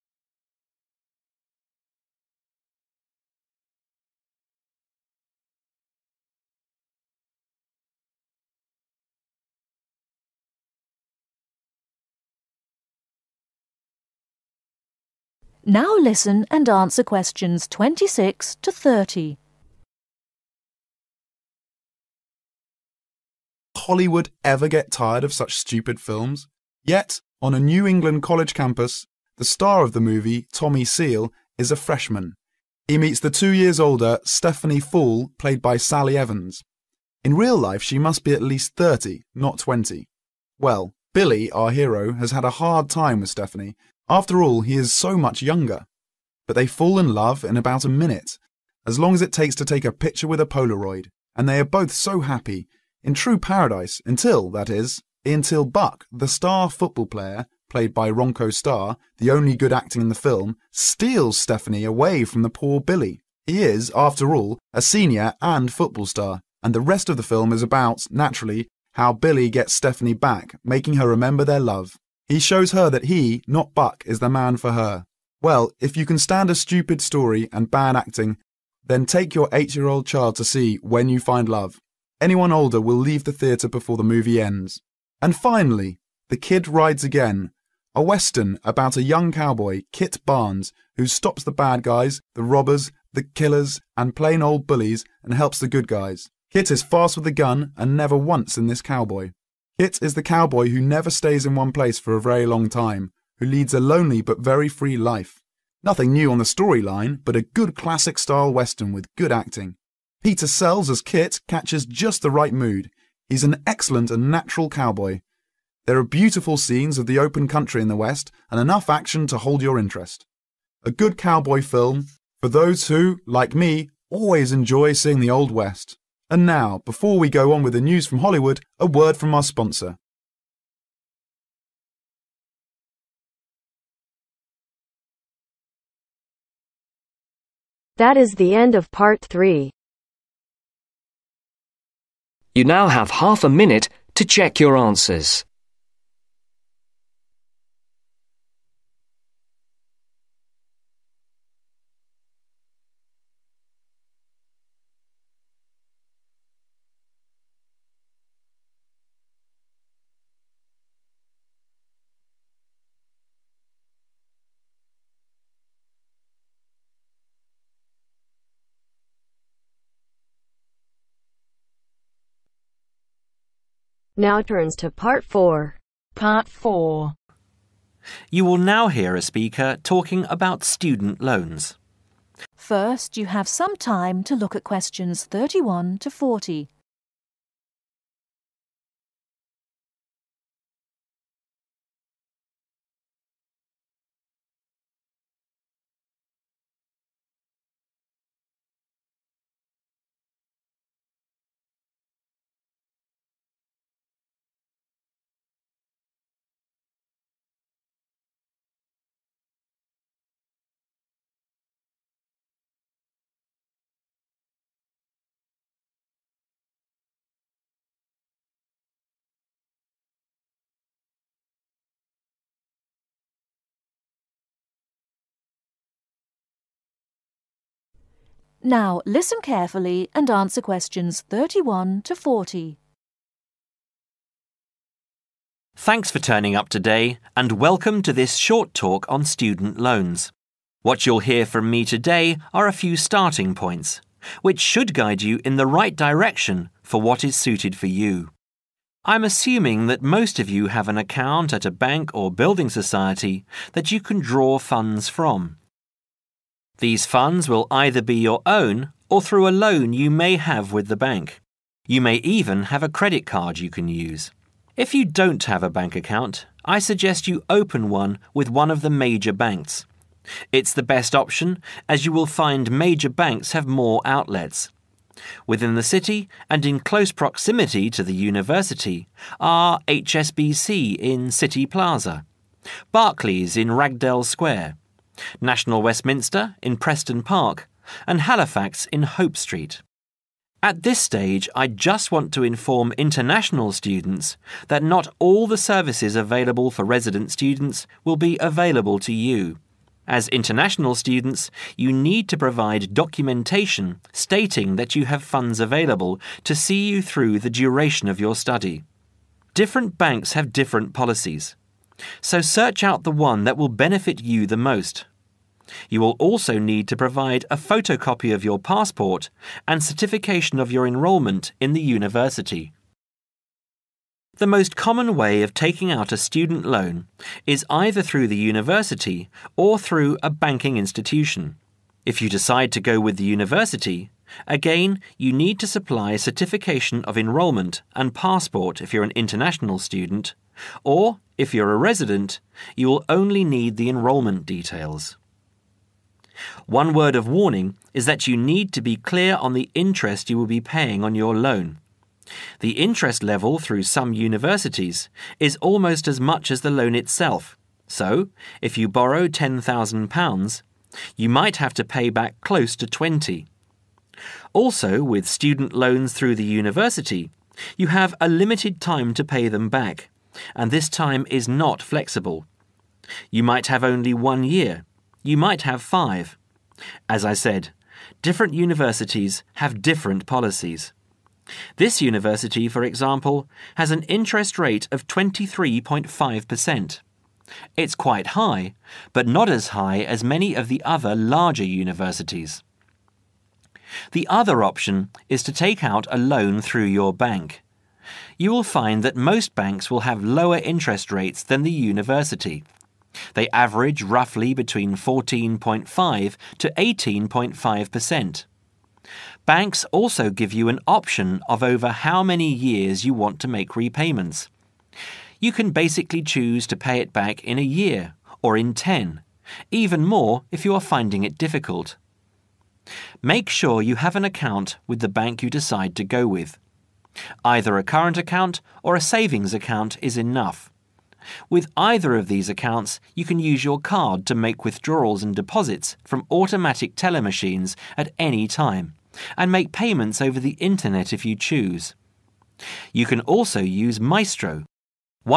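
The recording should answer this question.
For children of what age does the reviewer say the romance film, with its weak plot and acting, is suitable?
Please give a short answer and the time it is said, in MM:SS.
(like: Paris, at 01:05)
8, at 01:19.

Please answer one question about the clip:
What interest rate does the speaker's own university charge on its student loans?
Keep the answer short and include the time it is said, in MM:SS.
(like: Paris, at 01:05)
23.5%, at 06:25.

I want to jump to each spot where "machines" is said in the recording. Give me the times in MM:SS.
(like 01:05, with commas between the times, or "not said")
07:17.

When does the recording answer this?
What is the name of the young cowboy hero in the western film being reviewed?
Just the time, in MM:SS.
01:29.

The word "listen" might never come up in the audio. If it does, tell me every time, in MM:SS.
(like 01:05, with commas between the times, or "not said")
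00:15, 03:49.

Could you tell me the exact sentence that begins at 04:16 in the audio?
These funds will either be your own or through a loan you may have with the bank.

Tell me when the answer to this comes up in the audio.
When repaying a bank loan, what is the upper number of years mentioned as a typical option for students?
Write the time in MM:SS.
06:58.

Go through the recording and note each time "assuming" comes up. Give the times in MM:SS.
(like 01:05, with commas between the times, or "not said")
04:09.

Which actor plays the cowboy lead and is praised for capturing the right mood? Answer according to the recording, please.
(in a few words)
Peter Sells.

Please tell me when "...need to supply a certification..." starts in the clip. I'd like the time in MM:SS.
05:35.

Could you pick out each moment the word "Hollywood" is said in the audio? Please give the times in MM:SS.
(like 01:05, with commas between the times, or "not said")
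00:23, 02:08.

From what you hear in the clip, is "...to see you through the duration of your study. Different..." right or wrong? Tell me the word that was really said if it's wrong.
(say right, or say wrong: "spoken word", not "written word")
right.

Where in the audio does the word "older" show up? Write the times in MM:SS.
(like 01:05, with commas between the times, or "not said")
00:33, 01:22.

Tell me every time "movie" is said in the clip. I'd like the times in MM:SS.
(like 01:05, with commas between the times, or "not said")
00:30, 01:24.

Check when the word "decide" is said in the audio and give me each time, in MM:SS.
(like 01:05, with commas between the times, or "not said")
05:32, 07:05.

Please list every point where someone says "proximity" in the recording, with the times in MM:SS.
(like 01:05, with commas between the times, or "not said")
04:37.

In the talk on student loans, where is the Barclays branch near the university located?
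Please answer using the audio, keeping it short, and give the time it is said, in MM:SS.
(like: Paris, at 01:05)
Ragdale Square, at 04:43.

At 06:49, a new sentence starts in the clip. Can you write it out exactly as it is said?
Banks also give you an option of over how many years you want to make repayments.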